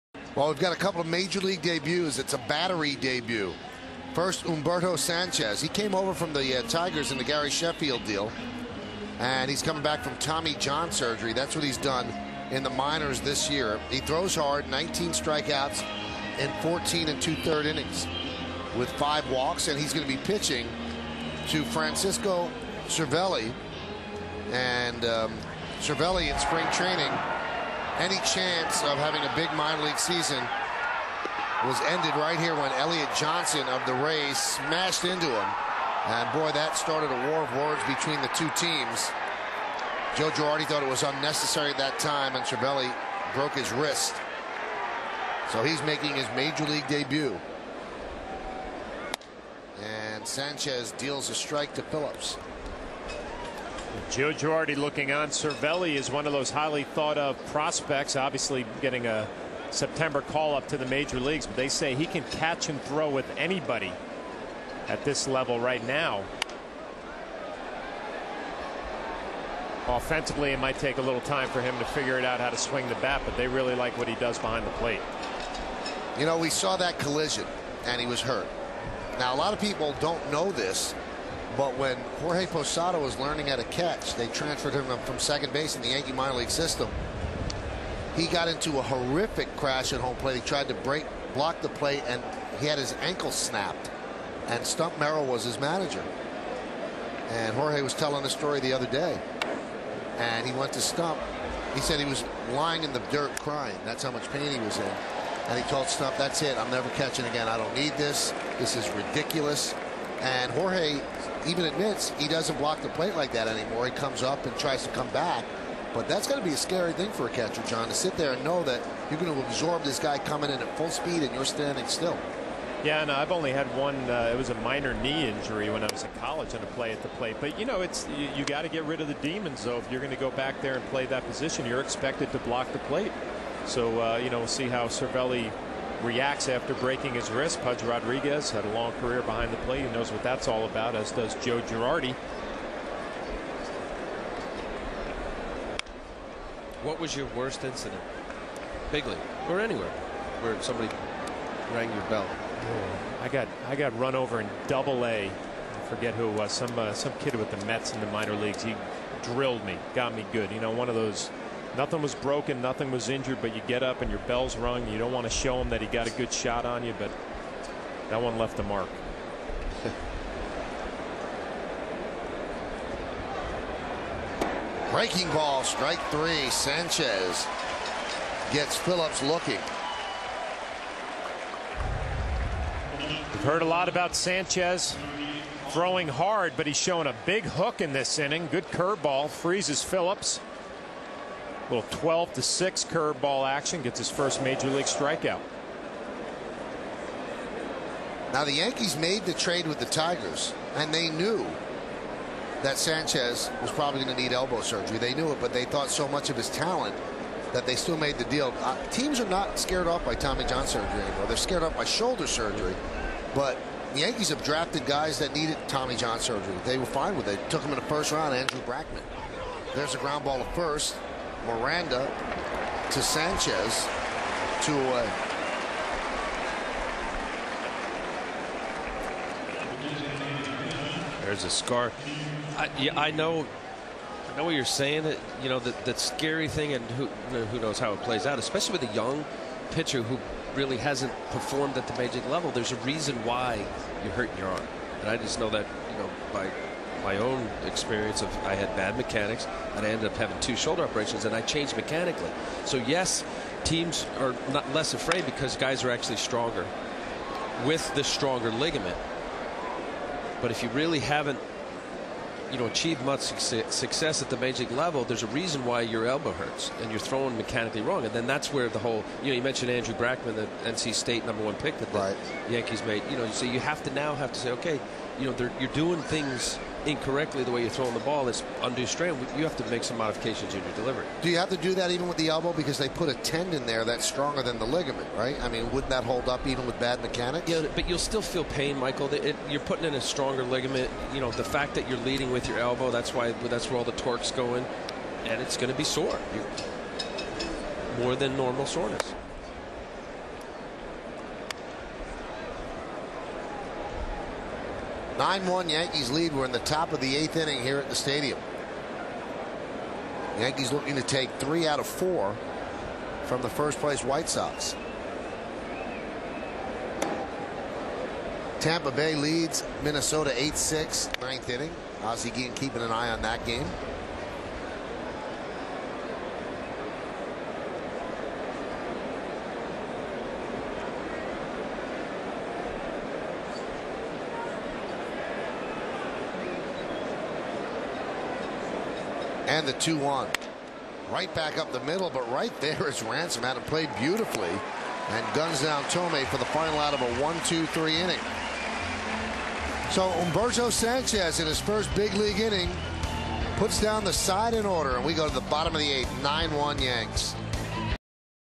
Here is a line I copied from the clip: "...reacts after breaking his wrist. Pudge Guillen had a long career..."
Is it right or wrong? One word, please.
wrong.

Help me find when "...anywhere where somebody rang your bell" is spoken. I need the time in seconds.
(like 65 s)
149 s.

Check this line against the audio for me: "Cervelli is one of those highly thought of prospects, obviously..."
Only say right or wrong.
right.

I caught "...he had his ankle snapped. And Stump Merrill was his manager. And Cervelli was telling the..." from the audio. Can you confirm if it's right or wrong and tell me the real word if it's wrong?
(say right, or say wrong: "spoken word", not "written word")
wrong: "Jorge", not "Cervelli".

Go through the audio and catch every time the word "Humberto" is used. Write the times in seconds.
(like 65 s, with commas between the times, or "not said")
4 s, 350 s.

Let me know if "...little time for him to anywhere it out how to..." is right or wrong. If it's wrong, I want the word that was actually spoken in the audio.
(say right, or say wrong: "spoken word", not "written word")
wrong: "figure", not "anywhere".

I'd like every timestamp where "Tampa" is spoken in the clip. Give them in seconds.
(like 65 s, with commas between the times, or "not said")
318 s.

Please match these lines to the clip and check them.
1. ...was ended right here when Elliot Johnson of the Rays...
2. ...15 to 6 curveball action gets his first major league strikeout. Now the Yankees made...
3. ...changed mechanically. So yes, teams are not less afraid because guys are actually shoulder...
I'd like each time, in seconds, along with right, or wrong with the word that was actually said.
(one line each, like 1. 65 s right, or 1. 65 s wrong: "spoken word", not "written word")
1. 31 s right
2. 191 s wrong: "12", not "15"
3. 251 s wrong: "stronger", not "shoulder".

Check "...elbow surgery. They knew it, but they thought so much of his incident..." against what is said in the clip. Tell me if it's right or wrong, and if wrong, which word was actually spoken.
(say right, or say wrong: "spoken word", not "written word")
wrong: "talent", not "incident".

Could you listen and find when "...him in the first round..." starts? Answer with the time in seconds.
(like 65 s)
217 s.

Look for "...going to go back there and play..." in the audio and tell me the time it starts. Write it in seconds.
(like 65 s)
129 s.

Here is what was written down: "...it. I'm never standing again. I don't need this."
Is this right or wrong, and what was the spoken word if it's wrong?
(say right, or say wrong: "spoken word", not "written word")
wrong: "catching", not "standing".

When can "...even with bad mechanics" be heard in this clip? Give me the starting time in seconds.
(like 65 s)
286 s.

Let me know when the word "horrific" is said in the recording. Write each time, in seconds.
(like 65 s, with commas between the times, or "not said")
88 s.